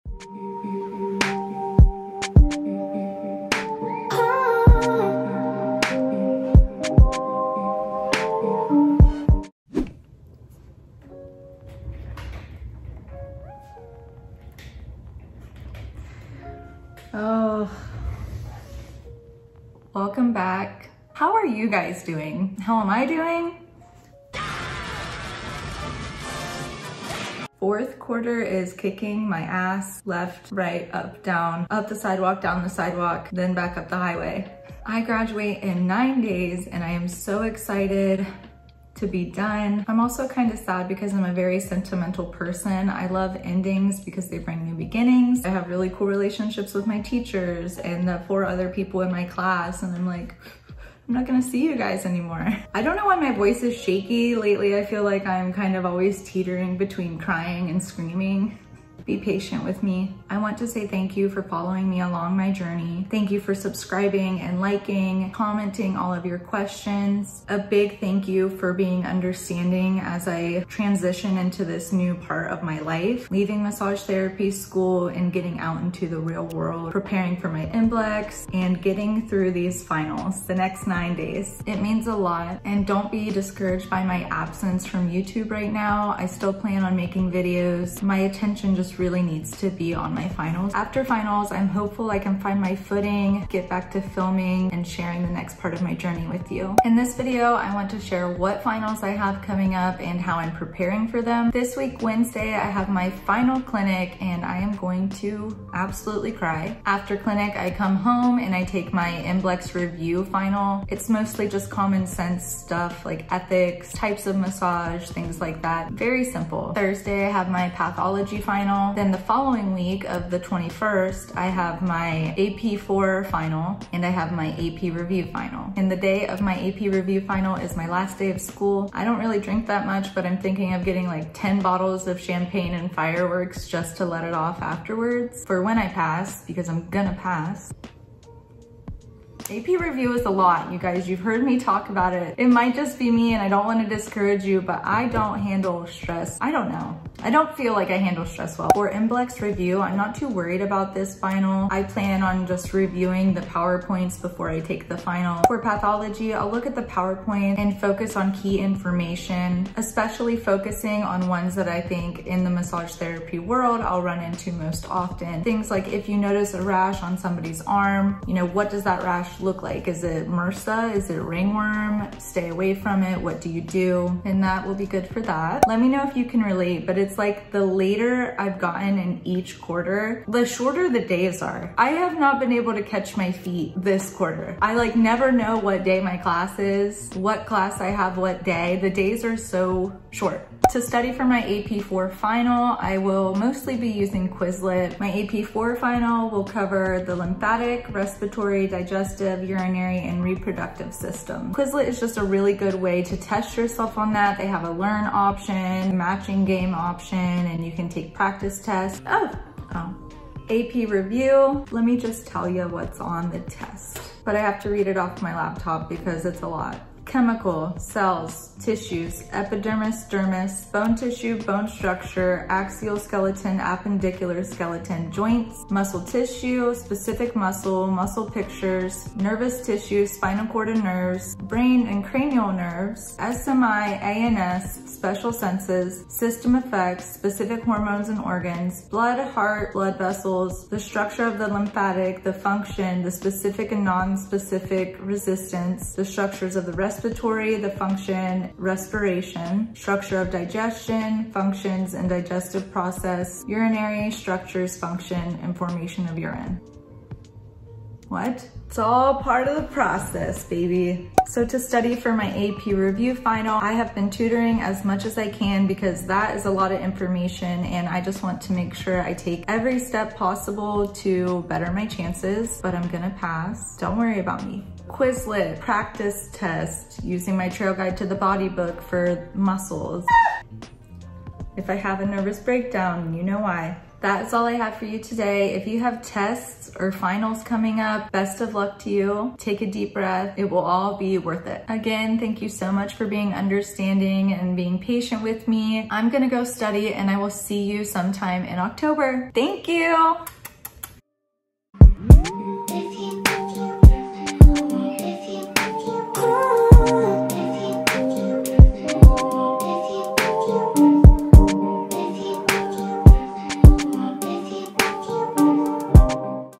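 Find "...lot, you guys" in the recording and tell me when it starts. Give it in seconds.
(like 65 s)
140 s.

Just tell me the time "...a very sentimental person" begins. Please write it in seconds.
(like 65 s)
41 s.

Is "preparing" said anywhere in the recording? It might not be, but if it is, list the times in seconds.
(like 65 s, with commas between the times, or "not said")
76 s, 100 s.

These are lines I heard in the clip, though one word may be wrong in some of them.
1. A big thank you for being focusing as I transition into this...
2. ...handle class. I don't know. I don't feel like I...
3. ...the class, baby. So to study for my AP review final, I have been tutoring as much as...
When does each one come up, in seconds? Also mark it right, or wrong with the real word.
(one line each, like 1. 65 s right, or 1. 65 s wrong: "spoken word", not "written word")
1. 67 s wrong: "understanding", not "focusing"
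2. 145 s wrong: "stress", not "class"
3. 259 s wrong: "process", not "class".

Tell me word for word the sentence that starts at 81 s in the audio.
It means a lot and don't be discouraged by my absence from YouTube right now.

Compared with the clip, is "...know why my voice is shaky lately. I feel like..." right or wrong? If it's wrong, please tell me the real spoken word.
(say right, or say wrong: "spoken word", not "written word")
right.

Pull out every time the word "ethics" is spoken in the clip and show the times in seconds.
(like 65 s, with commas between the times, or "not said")
113 s.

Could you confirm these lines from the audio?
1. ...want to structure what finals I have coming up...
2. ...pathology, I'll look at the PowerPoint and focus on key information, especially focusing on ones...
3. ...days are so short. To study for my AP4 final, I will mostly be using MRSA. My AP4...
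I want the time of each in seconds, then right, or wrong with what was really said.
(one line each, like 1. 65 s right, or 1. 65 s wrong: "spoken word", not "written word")
1. 97 s wrong: "share", not "structure"
2. 155 s right
3. 188 s wrong: "Quizlet", not "MRSA".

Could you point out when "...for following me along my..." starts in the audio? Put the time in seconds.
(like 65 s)
61 s.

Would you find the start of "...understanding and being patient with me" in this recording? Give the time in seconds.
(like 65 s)
293 s.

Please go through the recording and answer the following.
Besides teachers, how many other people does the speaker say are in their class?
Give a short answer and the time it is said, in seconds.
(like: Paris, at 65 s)
4, at 48 s.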